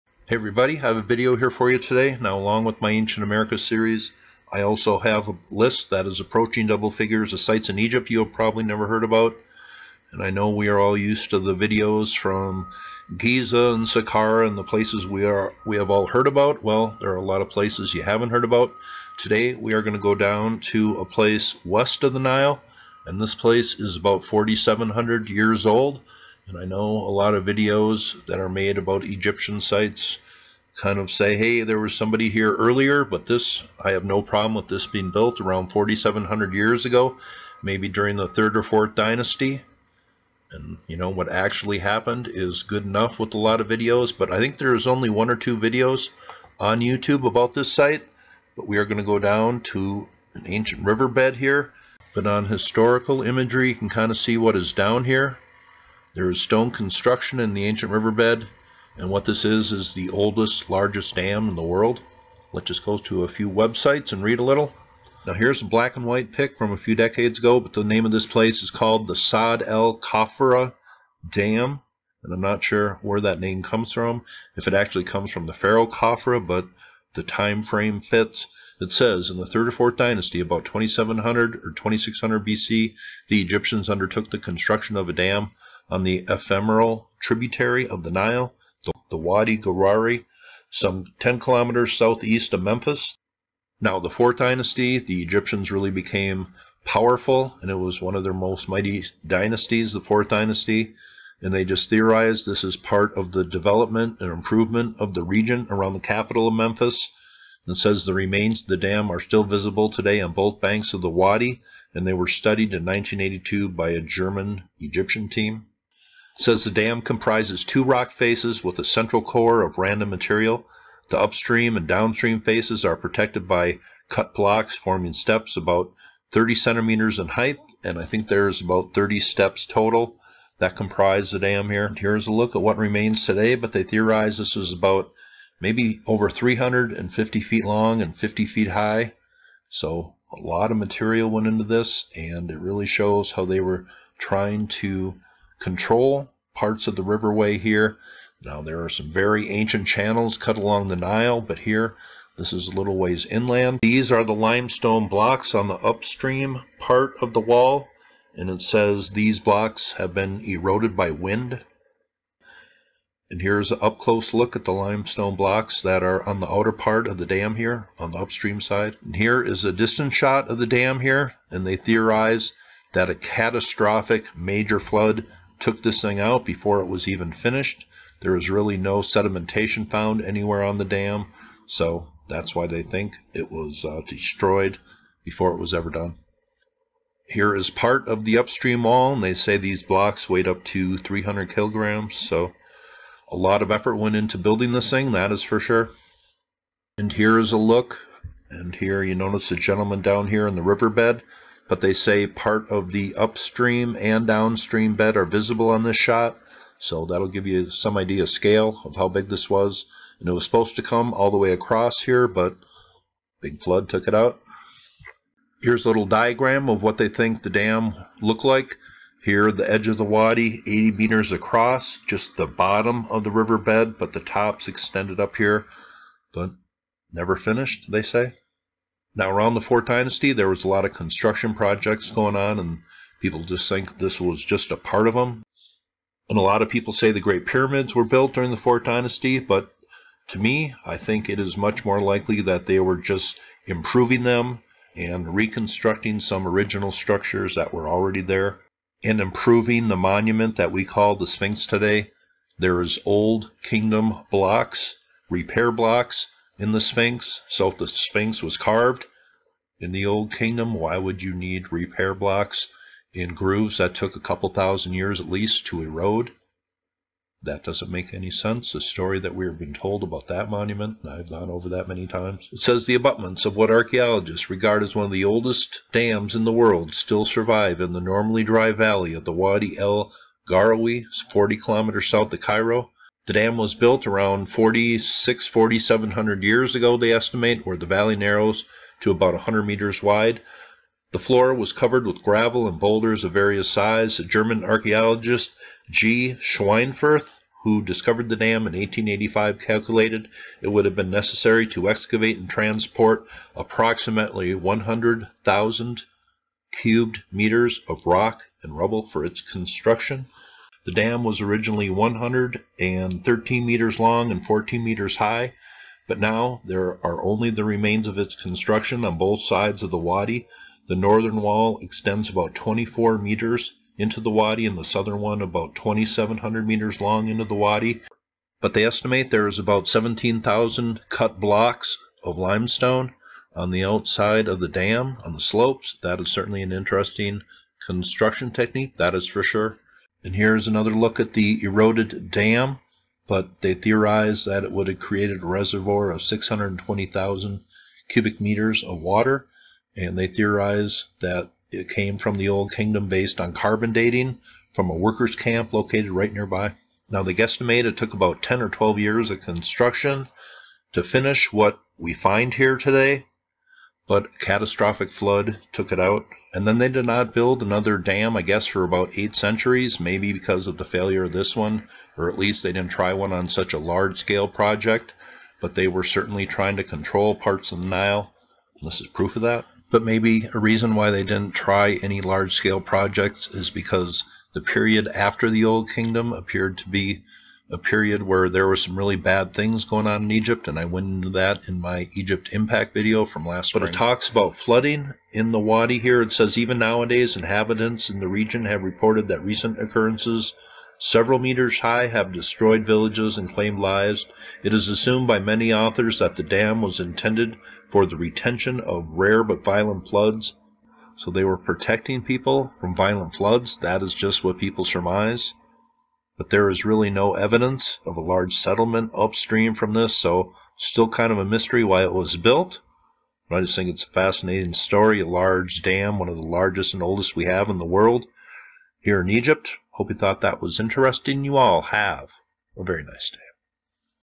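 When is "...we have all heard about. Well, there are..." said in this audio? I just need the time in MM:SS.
00:15.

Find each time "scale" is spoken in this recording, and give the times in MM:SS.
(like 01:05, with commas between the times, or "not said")
03:28, 06:14, 06:22.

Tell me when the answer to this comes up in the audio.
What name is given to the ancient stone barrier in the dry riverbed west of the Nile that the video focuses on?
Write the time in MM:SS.
01:09.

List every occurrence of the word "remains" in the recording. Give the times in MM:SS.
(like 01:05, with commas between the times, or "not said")
01:48, 02:12, 05:17.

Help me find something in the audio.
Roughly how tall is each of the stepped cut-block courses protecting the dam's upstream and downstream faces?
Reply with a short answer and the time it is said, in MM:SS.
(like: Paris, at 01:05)
30 centimeters, at 02:06.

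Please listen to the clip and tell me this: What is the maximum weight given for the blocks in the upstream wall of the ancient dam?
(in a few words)
300 kilograms.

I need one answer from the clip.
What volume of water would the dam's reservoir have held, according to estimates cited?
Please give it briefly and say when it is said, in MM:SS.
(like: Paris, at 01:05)
620,000 cubic meters, at 05:46.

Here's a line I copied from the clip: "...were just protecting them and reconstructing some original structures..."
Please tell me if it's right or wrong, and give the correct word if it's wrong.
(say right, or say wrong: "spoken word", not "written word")
wrong: "improving", not "protecting".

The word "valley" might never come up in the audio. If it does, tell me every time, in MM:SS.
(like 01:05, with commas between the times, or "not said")
04:38, 04:47.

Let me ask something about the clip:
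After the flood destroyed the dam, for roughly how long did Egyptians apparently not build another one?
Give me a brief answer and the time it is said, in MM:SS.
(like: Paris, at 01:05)
eight centuries, at 06:09.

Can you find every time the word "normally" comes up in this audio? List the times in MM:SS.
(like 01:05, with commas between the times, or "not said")
04:38.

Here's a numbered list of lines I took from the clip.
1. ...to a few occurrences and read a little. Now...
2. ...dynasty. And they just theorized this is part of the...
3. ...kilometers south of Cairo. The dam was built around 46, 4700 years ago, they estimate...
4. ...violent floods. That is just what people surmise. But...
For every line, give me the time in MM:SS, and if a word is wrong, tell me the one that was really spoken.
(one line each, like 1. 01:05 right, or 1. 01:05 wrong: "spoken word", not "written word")
1. 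01:02 wrong: "websites", not "occurrences"
2. 01:40 right
3. 04:41 right
4. 06:52 right.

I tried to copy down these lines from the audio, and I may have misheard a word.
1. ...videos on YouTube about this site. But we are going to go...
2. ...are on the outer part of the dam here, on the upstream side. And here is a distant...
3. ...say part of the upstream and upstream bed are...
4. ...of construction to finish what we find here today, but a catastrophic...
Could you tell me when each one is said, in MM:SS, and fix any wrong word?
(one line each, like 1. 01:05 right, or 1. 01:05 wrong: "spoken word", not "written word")
1. 00:45 right
2. 02:46 right
3. 03:21 wrong: "downstream", not "upstream"
4. 05:59 right.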